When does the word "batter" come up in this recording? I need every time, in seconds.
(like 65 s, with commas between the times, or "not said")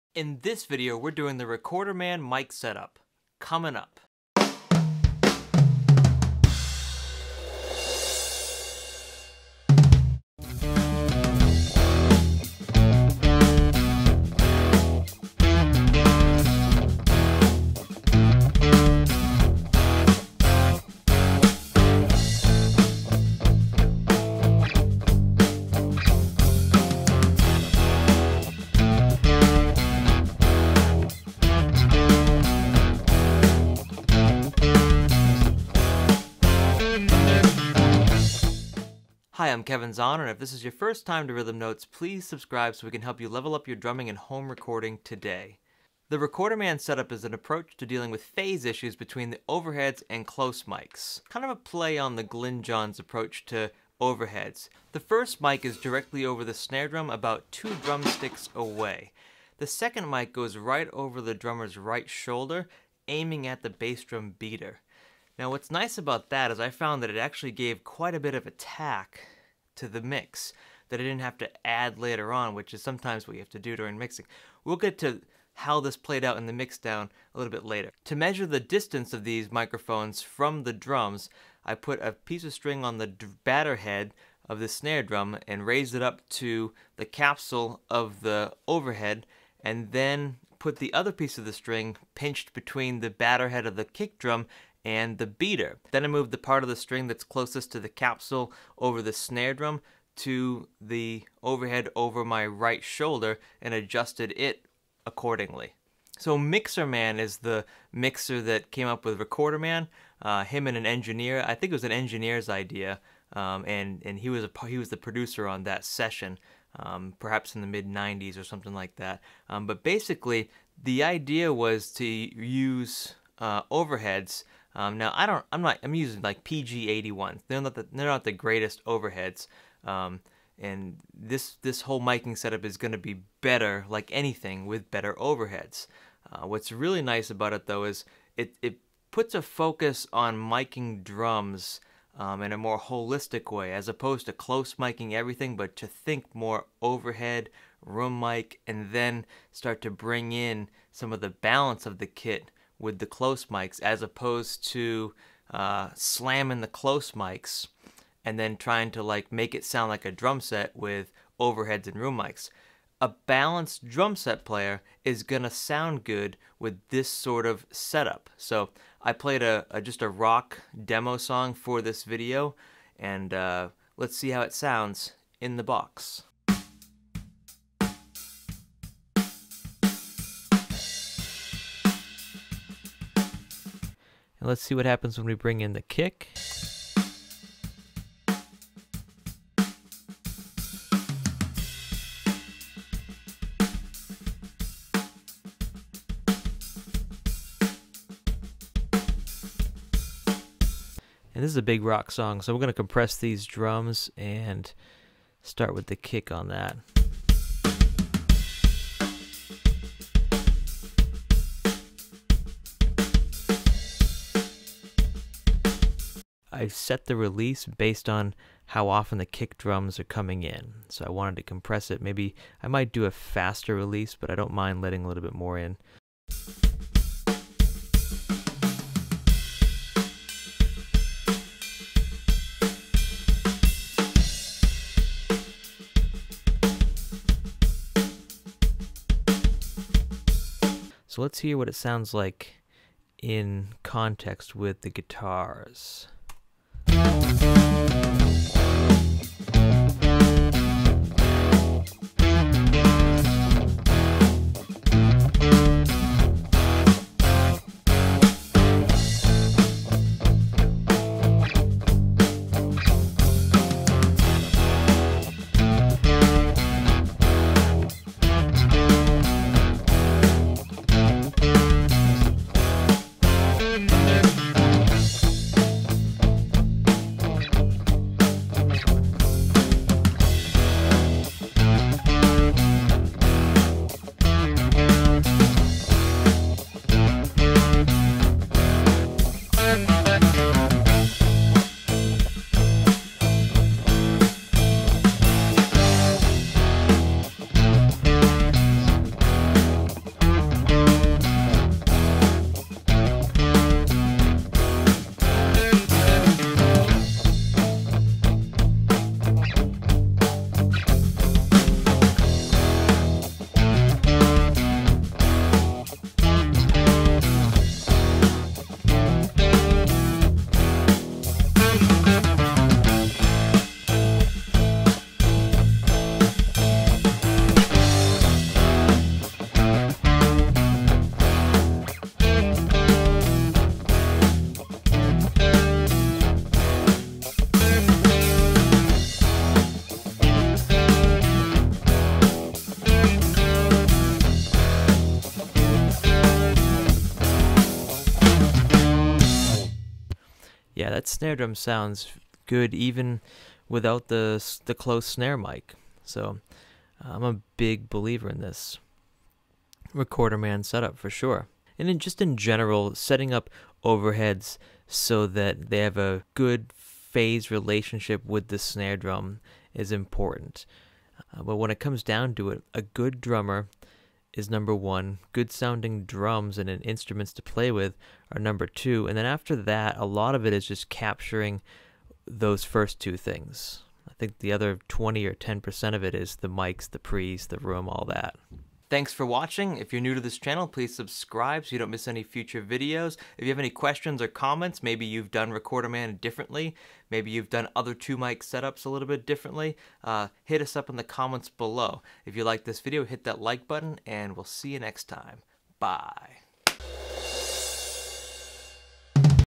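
83 s, 93 s.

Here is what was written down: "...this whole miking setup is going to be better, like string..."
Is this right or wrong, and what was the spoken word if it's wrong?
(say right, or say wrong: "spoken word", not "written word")
wrong: "anything", not "string".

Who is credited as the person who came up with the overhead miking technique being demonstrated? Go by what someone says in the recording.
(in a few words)
Mixer Man.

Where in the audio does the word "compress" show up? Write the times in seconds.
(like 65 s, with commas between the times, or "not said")
202 s, 221 s.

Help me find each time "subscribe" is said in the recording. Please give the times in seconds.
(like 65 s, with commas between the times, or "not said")
42 s, 390 s.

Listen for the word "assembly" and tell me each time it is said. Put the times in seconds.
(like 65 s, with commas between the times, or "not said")
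not said.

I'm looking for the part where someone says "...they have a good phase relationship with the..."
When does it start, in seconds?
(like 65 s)
365 s.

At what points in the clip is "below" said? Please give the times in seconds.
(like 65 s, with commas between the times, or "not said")
401 s.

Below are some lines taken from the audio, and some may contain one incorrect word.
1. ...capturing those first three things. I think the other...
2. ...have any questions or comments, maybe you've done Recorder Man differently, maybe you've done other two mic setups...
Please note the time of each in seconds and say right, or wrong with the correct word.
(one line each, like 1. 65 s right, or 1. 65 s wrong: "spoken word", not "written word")
1. 380 s wrong: "two", not "three"
2. 393 s right.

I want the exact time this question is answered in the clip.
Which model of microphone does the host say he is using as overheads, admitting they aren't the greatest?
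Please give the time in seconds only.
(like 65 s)
126 s.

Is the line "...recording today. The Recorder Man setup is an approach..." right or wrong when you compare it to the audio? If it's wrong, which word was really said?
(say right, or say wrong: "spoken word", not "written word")
right.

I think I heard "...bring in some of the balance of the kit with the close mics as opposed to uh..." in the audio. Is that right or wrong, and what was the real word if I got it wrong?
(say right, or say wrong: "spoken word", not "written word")
right.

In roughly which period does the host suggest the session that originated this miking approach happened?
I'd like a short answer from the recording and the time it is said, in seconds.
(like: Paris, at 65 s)
mid '90s, at 117 s.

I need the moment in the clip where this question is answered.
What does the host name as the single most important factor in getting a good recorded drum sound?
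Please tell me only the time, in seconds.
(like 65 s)
372 s.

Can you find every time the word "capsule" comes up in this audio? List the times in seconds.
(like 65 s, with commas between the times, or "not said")
87 s, 97 s.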